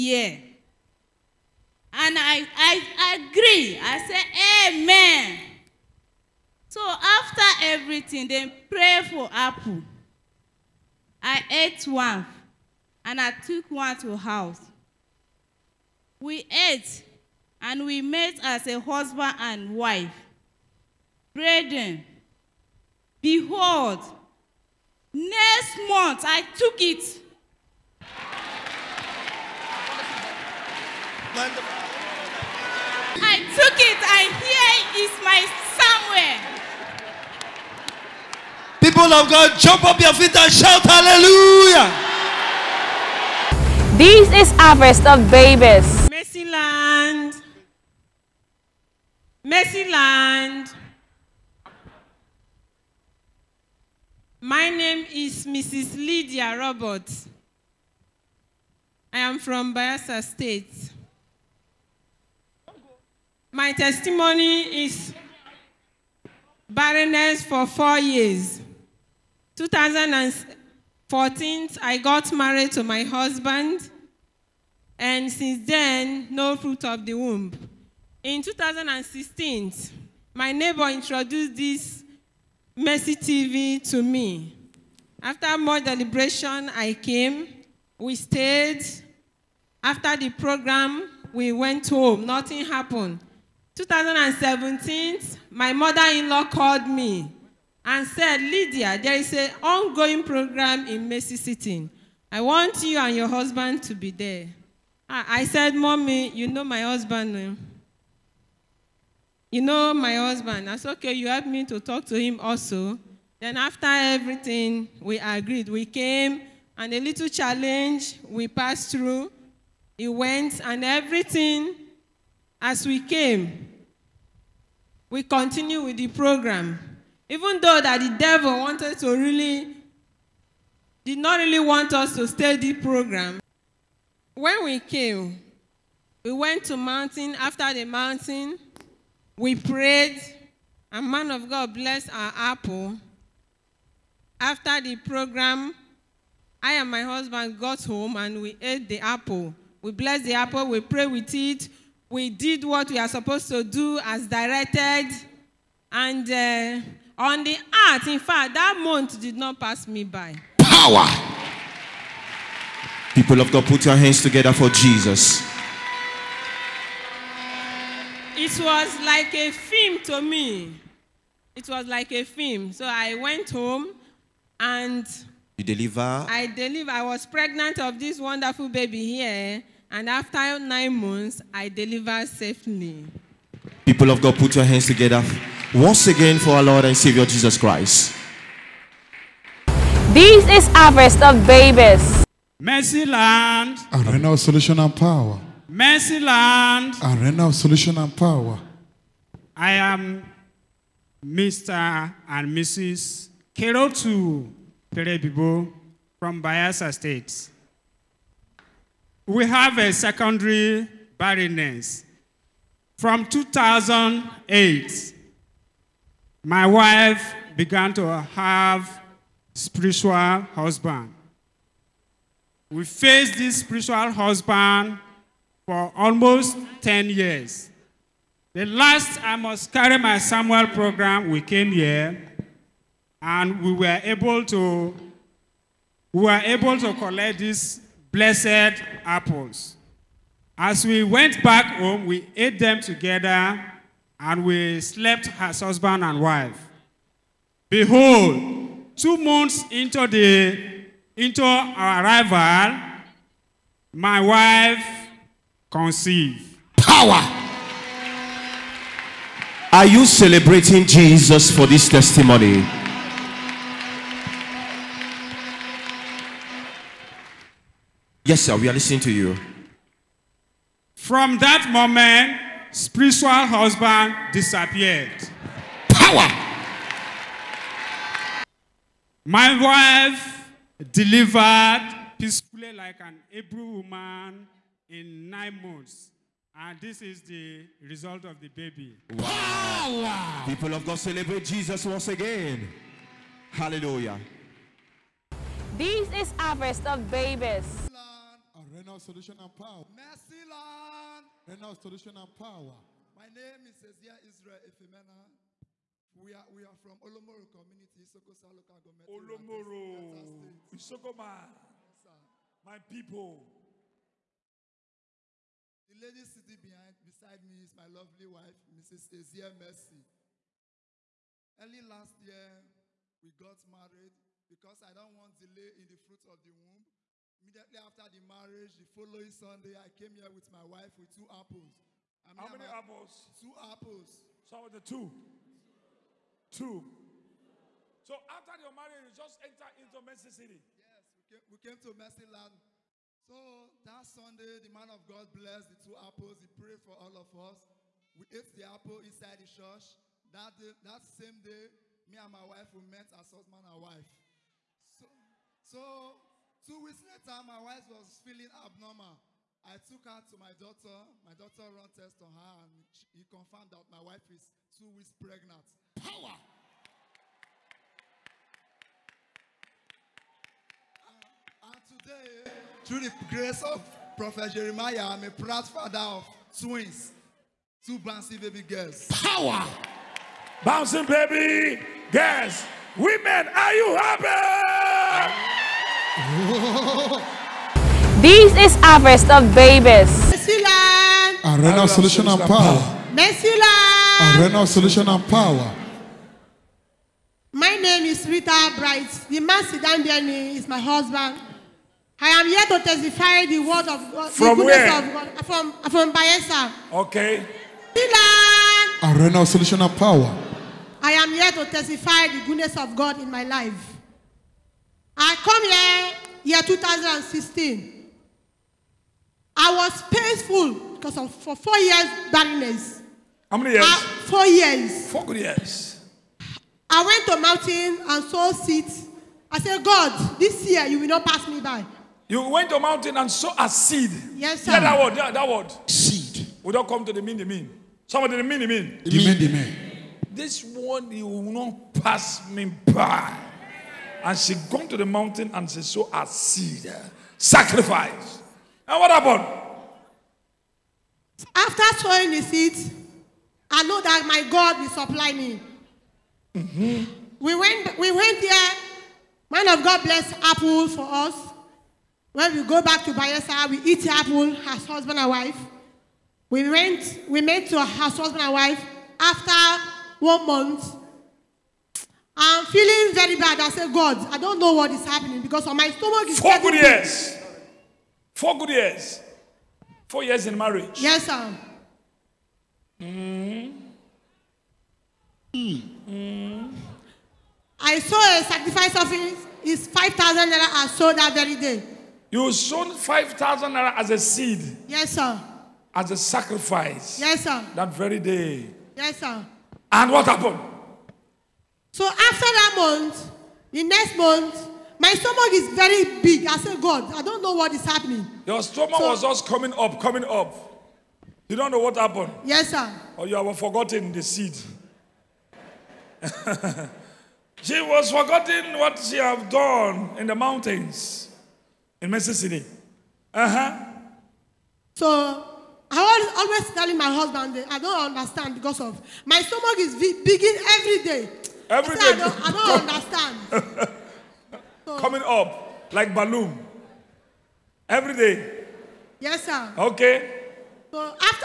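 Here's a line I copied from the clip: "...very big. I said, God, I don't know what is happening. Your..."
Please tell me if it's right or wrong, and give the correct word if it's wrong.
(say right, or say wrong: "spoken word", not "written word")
right.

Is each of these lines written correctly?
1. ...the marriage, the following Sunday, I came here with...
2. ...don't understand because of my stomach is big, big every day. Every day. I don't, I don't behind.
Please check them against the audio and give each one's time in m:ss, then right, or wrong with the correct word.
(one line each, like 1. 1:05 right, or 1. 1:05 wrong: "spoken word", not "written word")
1. 5:28 right
2. 8:47 wrong: "understand", not "behind".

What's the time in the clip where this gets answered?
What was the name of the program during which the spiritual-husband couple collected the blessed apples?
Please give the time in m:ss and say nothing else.
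3:49.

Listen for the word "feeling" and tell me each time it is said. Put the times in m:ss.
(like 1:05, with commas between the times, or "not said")
5:58, 7:52.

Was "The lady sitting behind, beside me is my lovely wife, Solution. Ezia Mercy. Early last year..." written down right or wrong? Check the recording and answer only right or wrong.
wrong.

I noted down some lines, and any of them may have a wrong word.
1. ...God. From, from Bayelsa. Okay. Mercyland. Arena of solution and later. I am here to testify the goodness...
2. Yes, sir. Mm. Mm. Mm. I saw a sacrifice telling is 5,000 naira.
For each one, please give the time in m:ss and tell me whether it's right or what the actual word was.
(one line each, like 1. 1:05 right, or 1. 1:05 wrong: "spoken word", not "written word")
1. 6:45 wrong: "power", not "later"
2. 8:01 wrong: "offering", not "telling".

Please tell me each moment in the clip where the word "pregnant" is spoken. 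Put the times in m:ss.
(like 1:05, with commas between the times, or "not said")
2:57, 6:05.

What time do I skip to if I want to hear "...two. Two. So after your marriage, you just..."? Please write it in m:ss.
5:34.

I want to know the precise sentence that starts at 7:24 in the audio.
And she gone to the mountain and she saw a seed.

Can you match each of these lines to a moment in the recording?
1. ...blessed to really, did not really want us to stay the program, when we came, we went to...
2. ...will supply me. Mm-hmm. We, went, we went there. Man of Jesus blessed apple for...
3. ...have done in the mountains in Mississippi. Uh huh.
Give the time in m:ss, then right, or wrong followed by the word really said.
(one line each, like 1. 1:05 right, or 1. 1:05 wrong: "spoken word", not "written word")
1. 2:08 wrong: "wanted", not "blessed"
2. 7:34 wrong: "God", not "Jesus"
3. 8:39 right.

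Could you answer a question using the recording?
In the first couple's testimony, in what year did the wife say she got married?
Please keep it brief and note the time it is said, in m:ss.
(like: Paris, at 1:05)
2014, at 1:09.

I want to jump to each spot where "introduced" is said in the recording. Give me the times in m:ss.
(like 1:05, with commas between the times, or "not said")
1:20.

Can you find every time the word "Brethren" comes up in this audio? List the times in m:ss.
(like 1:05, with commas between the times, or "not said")
0:21.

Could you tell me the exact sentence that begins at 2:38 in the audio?
In fact, that month did not pass me by.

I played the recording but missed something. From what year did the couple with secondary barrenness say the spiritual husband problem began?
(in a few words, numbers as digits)
2008.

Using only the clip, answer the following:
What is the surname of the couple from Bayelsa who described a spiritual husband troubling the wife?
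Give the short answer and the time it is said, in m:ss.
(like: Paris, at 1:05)
Perebibo, at 3:24.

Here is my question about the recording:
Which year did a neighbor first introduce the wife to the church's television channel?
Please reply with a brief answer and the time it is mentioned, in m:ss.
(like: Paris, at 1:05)
2016, at 1:18.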